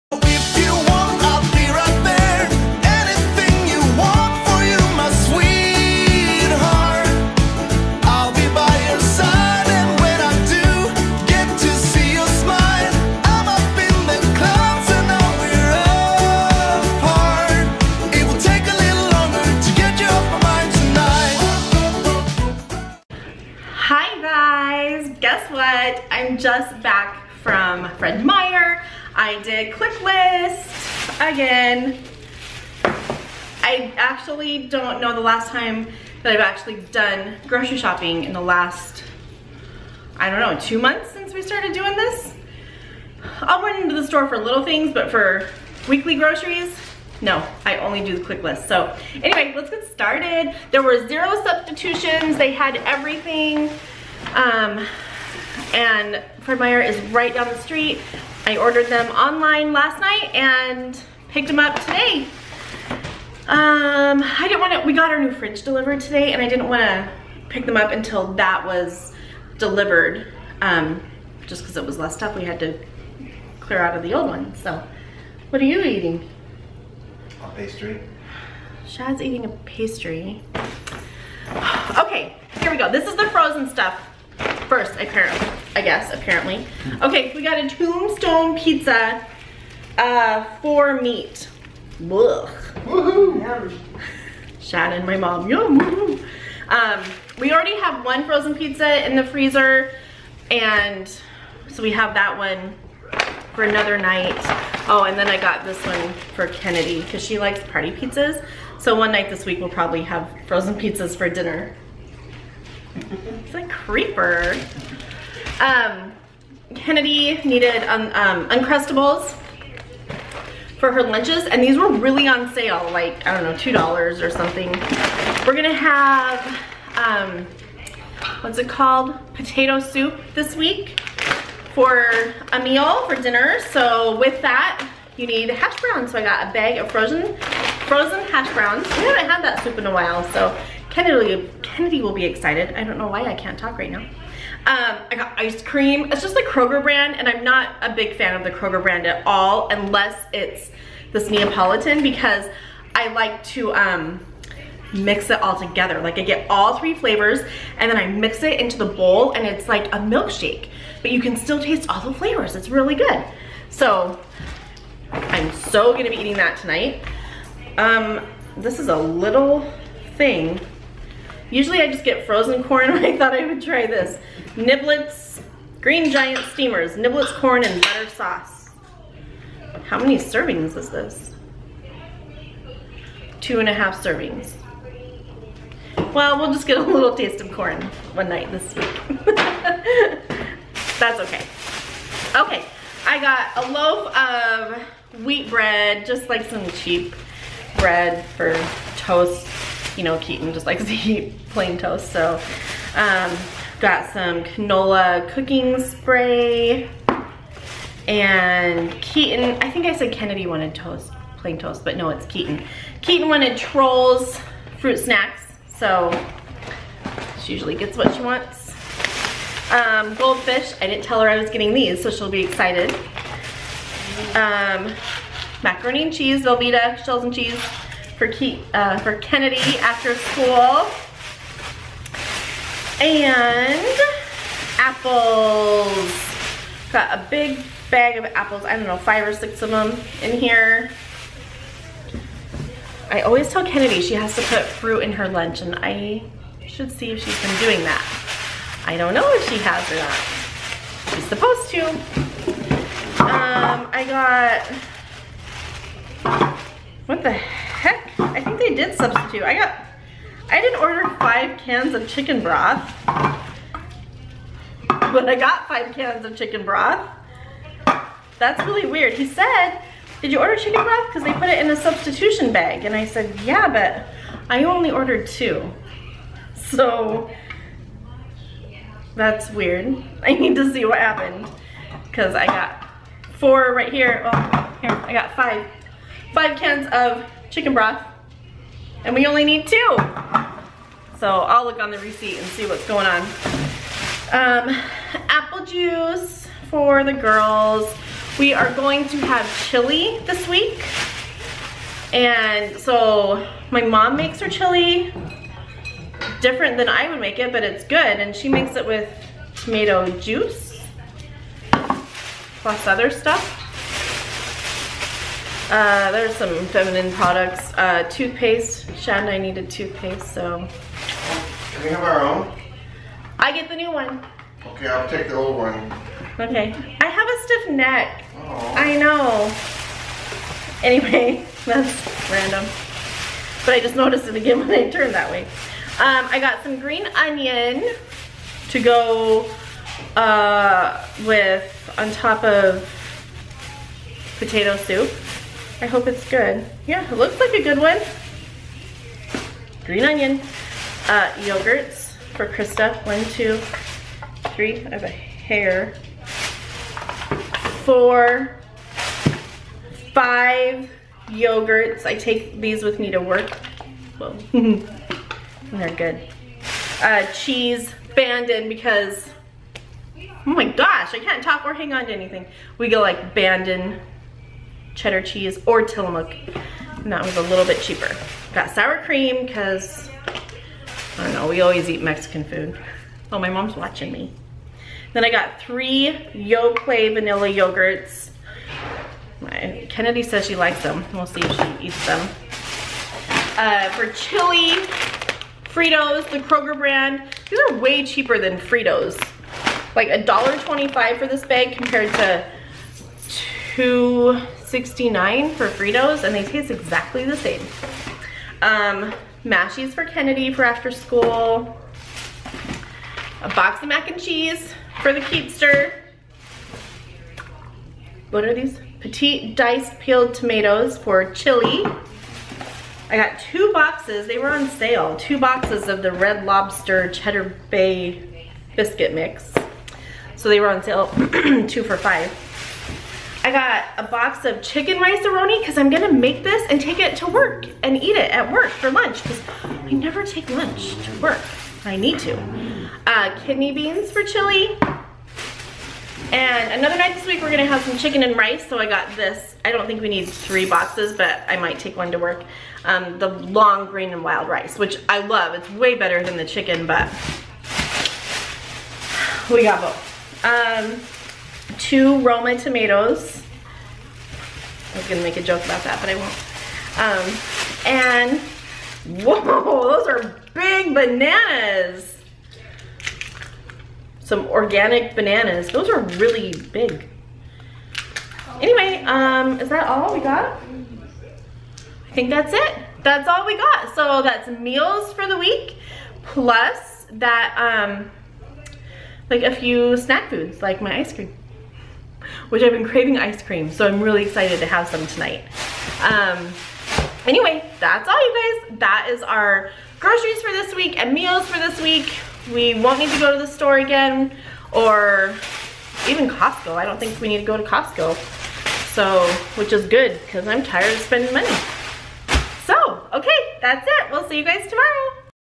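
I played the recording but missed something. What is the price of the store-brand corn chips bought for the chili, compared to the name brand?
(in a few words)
$1.25.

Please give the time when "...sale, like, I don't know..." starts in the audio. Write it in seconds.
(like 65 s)
122 s.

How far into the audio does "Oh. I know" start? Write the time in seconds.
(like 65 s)
328 s.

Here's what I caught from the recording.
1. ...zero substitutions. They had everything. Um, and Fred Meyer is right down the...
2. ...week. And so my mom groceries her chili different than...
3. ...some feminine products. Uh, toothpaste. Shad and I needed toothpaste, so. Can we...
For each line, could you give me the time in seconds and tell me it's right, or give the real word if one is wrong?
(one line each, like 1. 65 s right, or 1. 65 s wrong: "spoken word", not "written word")
1. 51 s right
2. 300 s wrong: "makes", not "groceries"
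3. 316 s right.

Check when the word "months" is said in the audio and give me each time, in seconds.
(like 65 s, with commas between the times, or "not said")
40 s.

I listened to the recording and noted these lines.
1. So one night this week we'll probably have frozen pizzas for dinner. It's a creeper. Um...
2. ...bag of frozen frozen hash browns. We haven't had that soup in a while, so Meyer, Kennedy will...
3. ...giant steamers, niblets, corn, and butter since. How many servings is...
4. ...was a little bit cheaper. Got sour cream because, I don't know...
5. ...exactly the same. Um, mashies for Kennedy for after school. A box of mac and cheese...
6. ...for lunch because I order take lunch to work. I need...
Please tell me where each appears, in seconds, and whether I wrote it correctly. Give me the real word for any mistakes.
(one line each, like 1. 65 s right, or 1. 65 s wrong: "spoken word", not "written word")
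1. 108 s right
2. 136 s wrong: "Kennedy", not "Meyer"
3. 176 s wrong: "sauce", not "since"
4. 377 s right
5. 406 s right
6. 438 s wrong: "never", not "order".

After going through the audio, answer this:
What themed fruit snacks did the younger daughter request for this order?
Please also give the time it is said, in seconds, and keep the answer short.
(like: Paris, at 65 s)
Trolls, at 213 s.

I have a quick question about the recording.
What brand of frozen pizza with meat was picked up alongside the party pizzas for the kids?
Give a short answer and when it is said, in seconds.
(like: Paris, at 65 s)
Tombstone, at 87 s.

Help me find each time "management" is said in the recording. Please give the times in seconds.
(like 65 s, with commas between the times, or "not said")
not said.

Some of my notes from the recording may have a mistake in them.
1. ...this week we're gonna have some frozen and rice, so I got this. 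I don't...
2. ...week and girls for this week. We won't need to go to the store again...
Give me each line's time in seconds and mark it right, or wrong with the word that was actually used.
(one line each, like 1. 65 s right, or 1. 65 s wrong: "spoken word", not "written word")
1. 447 s wrong: "chicken", not "frozen"
2. 500 s wrong: "meals", not "girls".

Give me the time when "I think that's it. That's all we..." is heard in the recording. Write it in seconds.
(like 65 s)
482 s.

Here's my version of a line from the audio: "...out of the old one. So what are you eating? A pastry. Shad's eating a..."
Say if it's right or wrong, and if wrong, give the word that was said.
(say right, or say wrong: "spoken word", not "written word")
right.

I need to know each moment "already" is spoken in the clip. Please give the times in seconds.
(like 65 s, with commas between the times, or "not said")
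97 s.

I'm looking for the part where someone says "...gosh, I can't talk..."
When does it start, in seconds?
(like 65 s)
370 s.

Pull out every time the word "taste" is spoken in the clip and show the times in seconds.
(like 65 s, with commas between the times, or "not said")
161 s, 187 s, 406 s.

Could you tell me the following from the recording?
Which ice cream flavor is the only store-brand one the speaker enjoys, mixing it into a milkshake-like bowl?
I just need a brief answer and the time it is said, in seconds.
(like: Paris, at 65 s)
Neapolitan, at 151 s.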